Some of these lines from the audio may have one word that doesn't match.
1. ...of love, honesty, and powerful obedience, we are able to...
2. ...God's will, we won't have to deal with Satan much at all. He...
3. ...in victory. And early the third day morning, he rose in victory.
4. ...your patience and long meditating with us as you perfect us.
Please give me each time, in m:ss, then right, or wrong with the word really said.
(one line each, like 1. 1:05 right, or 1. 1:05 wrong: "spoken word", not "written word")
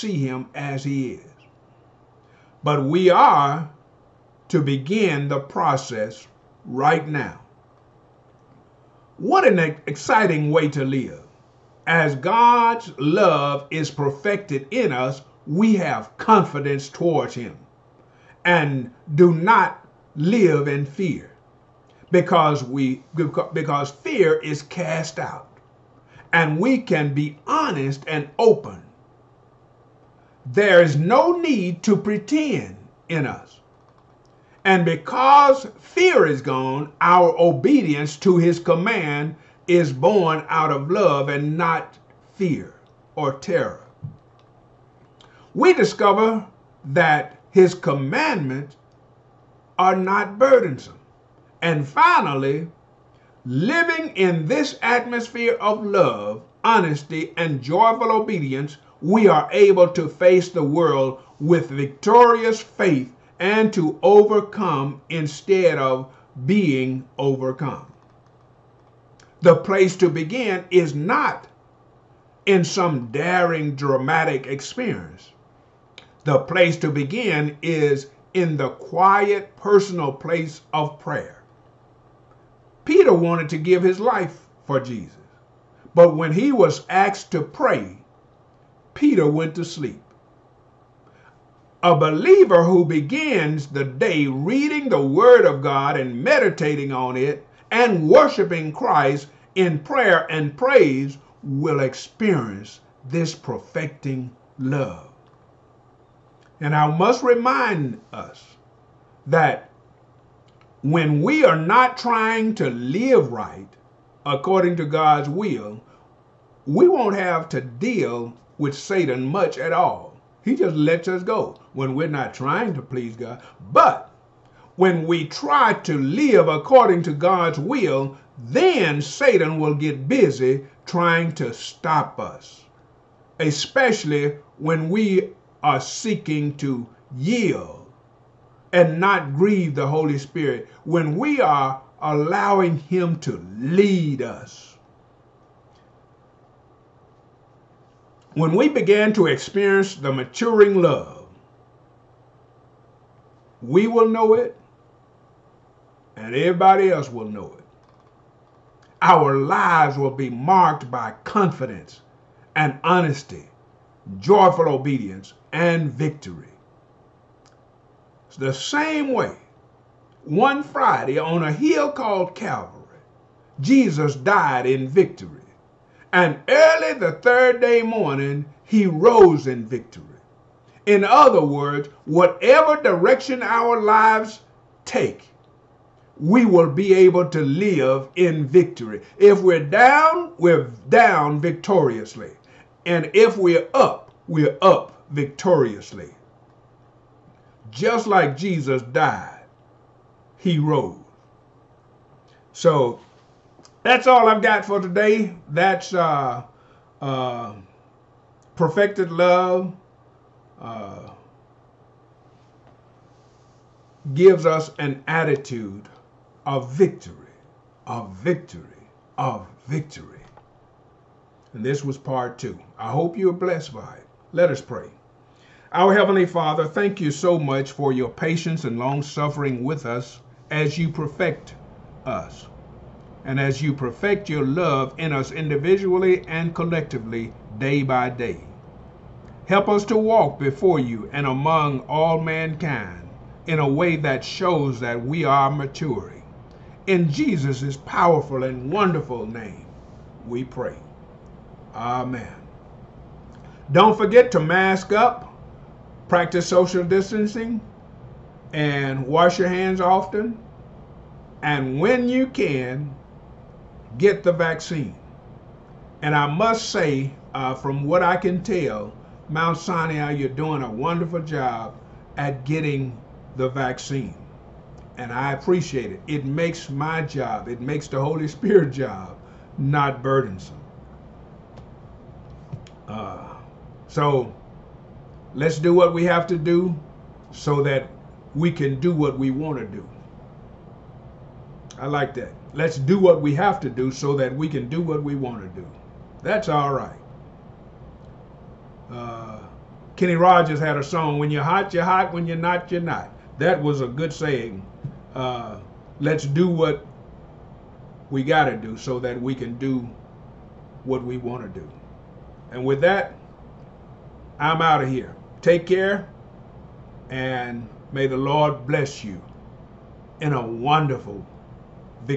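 1. 0:55 wrong: "joyful", not "powerful"
2. 1:54 right
3. 2:54 right
4. 3:47 wrong: "suffering", not "meditating".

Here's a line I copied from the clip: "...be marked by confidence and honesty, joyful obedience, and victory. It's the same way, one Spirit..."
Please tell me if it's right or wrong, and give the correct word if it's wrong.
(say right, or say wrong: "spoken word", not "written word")
wrong: "Friday", not "Spirit".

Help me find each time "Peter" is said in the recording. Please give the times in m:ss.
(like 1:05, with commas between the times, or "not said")
1:22, 1:28.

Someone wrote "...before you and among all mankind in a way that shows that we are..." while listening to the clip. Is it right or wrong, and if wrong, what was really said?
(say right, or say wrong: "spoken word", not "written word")
right.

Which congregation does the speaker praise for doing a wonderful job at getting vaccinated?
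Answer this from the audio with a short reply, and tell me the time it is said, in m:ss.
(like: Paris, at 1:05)
Mount Sinai, at 4:29.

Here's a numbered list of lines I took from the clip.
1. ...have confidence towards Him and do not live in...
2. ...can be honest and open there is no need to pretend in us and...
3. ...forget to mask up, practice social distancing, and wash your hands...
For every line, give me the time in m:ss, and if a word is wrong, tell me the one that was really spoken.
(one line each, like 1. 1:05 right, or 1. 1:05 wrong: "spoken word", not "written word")
1. 0:15 right
2. 0:26 right
3. 4:13 right.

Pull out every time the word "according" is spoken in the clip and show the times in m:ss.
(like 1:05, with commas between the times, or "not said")
1:54, 2:06.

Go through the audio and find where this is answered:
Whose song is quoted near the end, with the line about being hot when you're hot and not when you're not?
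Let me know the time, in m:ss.
4:59.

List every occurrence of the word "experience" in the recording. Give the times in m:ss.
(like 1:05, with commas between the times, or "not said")
1:14, 1:41, 2:29.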